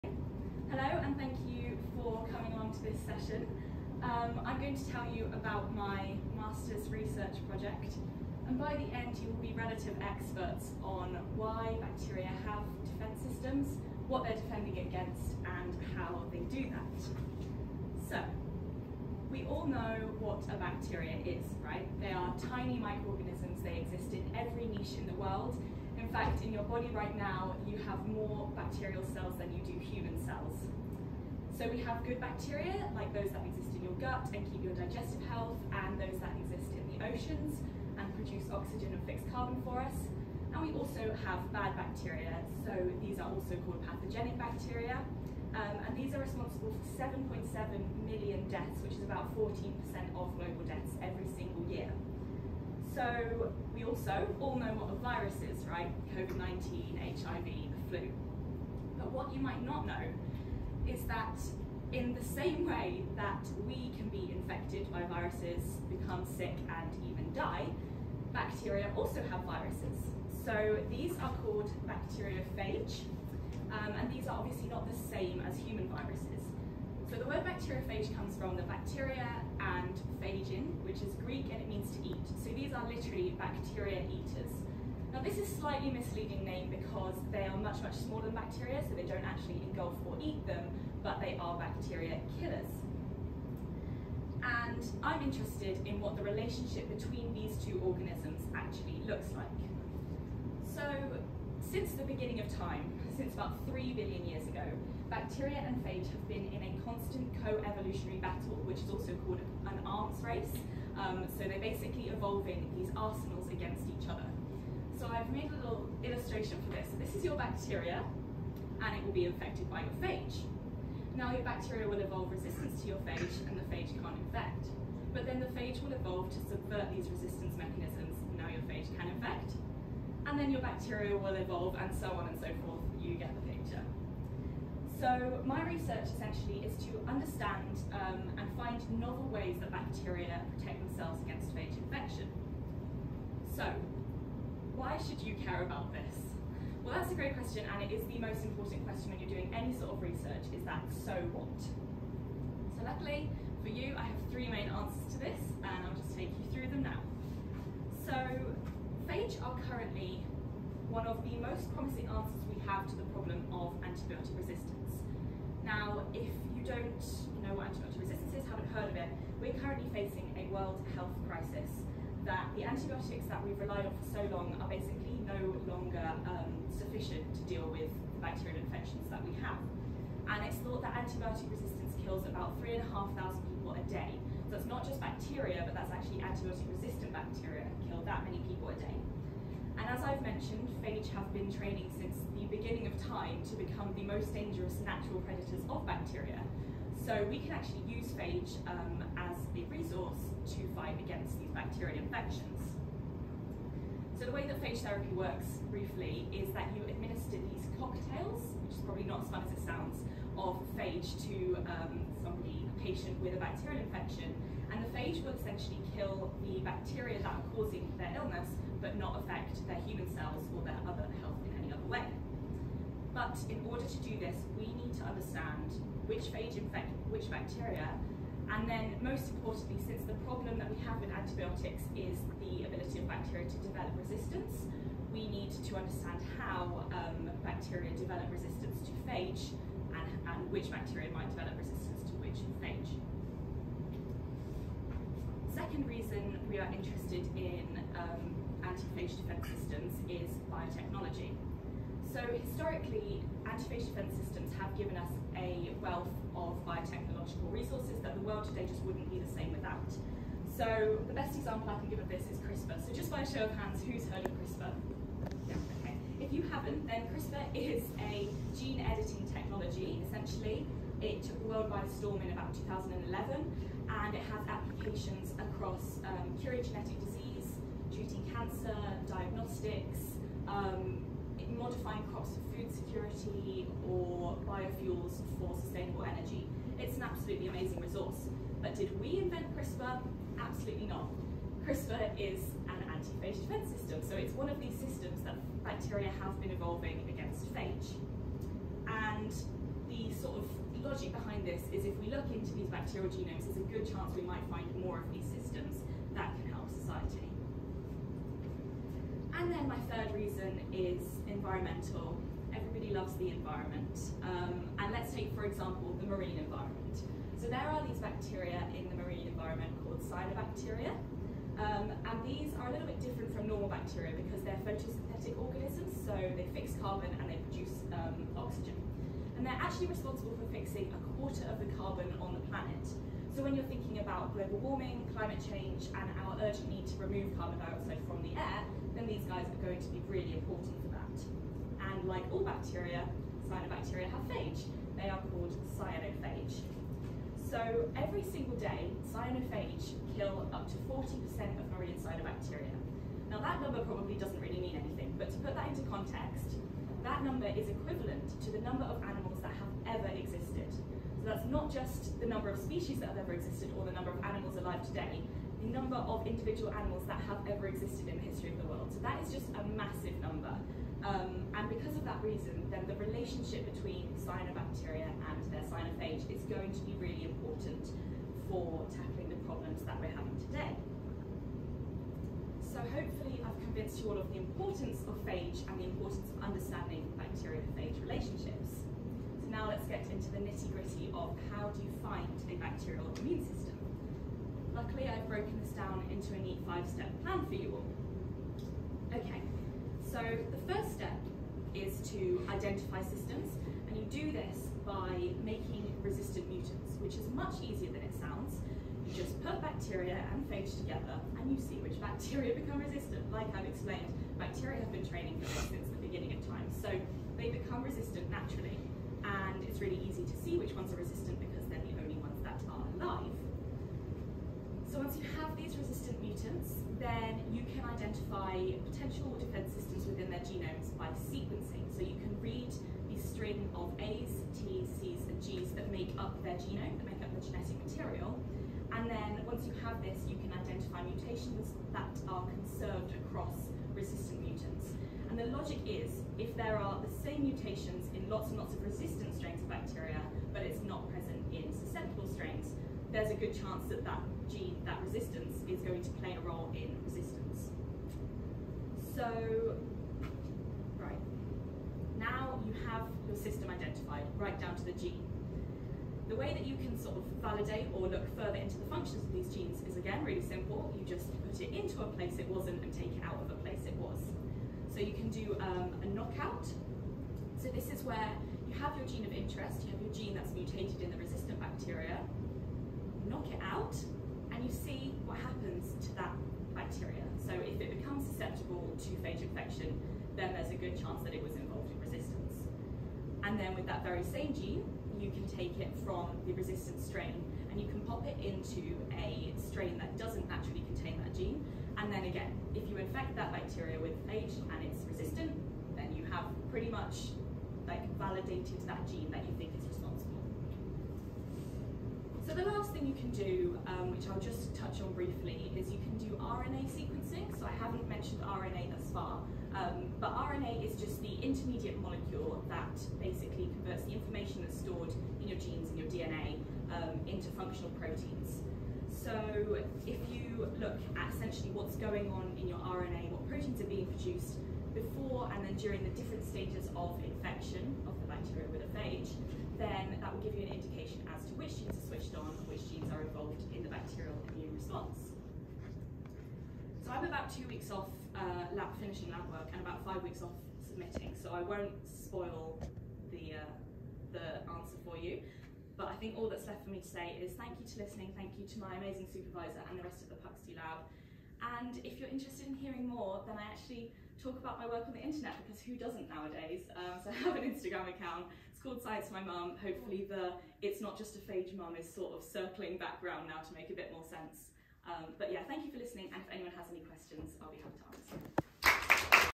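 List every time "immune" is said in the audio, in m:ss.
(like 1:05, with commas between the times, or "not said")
6:33, 9:04.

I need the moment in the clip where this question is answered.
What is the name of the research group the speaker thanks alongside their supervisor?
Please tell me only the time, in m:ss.
9:20.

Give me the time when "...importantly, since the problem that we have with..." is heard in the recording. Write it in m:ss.
3:49.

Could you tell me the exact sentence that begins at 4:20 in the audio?
So the best example I can give of this is CRISPR.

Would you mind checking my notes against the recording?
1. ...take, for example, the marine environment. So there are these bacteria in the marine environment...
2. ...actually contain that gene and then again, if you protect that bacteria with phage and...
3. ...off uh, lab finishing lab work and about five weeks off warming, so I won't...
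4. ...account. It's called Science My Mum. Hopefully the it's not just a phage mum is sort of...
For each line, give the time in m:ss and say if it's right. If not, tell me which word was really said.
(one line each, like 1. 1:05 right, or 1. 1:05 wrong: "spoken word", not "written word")
1. 5:15 right
2. 8:20 wrong: "infect", not "protect"
3. 9:07 wrong: "submitting", not "warming"
4. 9:28 right.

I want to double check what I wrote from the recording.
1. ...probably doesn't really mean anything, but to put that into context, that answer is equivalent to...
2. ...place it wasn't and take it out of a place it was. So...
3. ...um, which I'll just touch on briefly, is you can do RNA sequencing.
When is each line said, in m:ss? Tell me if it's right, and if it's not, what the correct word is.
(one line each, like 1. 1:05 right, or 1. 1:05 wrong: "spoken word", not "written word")
1. 5:53 wrong: "number", not "answer"
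2. 7:52 right
3. 8:33 right.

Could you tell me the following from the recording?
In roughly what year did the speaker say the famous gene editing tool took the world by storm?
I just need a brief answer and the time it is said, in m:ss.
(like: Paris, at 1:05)
2011, at 4:32.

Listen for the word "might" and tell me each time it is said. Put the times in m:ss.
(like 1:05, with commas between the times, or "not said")
0:59, 4:01, 5:04.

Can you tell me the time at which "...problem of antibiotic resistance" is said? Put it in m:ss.
2:43.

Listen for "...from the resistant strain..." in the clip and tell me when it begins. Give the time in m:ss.
8:16.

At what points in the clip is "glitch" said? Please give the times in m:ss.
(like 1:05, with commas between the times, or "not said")
not said.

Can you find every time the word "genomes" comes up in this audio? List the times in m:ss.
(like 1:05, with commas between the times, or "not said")
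5:03, 7:10, 7:16.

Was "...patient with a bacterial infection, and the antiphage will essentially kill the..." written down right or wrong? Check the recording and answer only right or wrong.
wrong.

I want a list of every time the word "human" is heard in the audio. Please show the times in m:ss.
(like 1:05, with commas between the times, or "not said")
0:29, 1:15, 3:39.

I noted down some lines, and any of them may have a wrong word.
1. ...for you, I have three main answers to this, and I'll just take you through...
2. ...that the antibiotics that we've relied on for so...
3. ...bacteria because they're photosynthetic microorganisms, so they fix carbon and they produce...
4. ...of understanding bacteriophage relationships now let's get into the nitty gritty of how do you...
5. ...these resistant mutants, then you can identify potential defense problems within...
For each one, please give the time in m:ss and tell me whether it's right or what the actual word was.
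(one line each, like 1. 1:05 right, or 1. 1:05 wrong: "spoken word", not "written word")
1. 2:33 right
2. 2:52 right
3. 5:23 wrong: "organisms", not "microorganisms"
4. 6:26 right
5. 7:05 wrong: "systems", not "problems".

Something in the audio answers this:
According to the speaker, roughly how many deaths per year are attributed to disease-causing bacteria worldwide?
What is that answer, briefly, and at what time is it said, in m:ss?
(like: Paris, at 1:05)
7.7 million, at 0:47.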